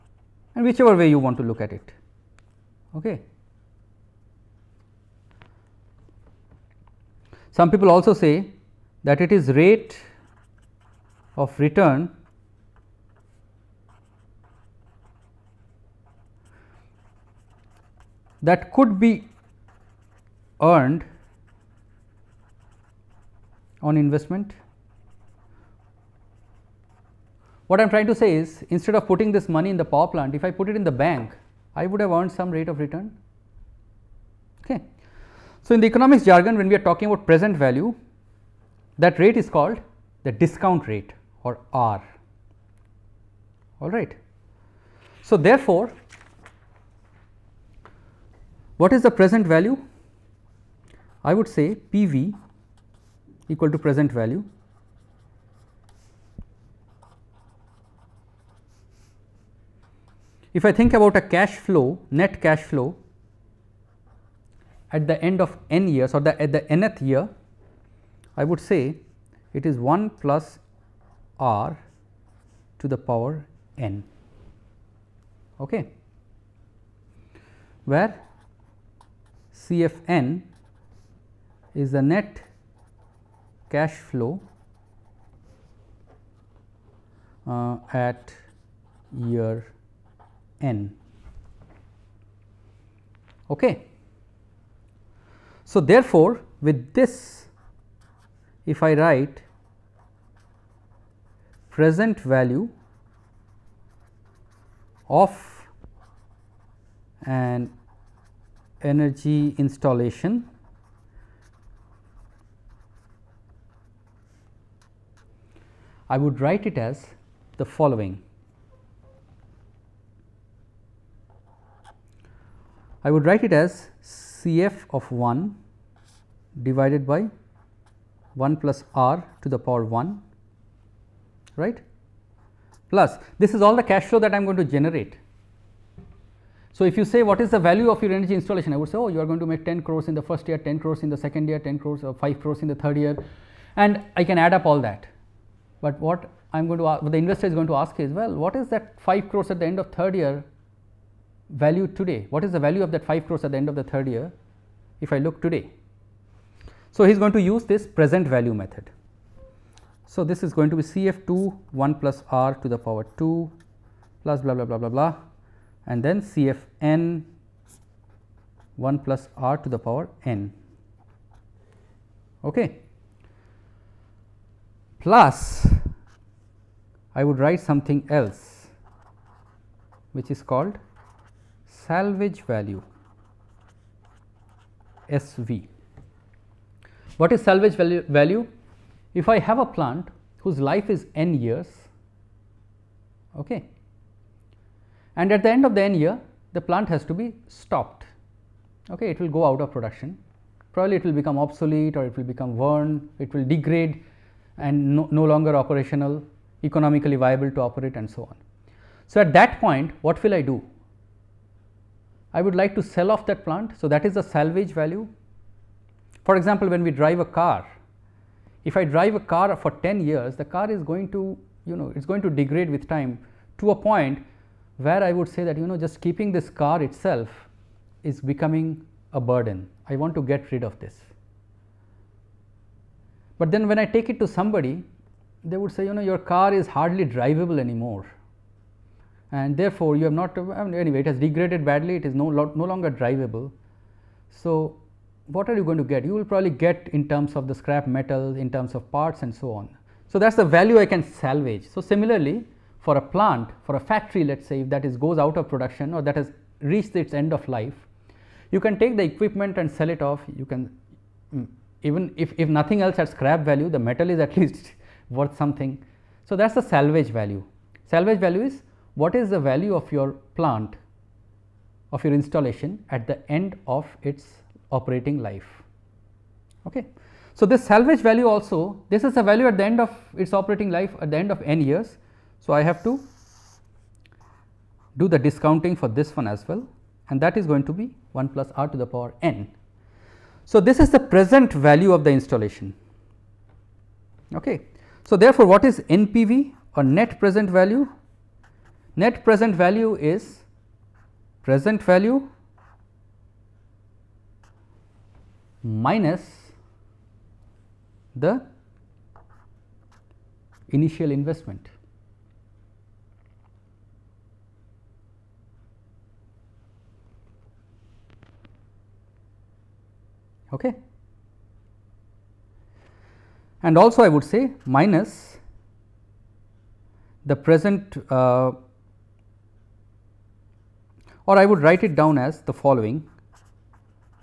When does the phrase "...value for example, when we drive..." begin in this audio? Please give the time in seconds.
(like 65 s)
214 s.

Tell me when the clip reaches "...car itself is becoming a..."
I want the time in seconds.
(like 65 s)
226 s.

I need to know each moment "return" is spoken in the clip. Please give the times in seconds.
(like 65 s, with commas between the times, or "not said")
11 s, 32 s.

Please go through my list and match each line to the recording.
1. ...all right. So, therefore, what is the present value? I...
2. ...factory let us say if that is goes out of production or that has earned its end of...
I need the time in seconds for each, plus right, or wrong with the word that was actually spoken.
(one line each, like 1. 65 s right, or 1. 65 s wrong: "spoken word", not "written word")
1. 43 s right
2. 253 s wrong: "reached", not "earned".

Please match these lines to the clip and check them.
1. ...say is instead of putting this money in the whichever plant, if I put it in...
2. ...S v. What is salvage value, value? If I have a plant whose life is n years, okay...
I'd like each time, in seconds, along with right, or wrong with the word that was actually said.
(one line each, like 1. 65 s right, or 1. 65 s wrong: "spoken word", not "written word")
1. 28 s wrong: "power", not "whichever"
2. 185 s right.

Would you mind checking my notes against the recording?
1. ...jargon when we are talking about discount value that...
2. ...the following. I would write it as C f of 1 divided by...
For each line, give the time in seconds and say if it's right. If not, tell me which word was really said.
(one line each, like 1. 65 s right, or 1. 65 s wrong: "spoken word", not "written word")
1. 36 s wrong: "present", not "discount"
2. 117 s right.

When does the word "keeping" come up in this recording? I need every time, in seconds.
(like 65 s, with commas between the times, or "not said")
225 s.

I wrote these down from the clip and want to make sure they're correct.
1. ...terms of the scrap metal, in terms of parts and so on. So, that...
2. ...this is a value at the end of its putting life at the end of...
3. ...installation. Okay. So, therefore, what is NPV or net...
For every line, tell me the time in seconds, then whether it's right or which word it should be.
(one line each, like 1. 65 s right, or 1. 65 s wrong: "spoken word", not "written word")
1. 247 s right
2. 278 s wrong: "operating", not "putting"
3. 292 s right.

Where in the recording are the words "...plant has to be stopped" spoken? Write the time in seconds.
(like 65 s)
196 s.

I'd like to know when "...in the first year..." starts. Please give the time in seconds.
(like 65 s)
140 s.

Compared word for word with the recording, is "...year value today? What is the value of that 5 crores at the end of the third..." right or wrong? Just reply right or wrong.
right.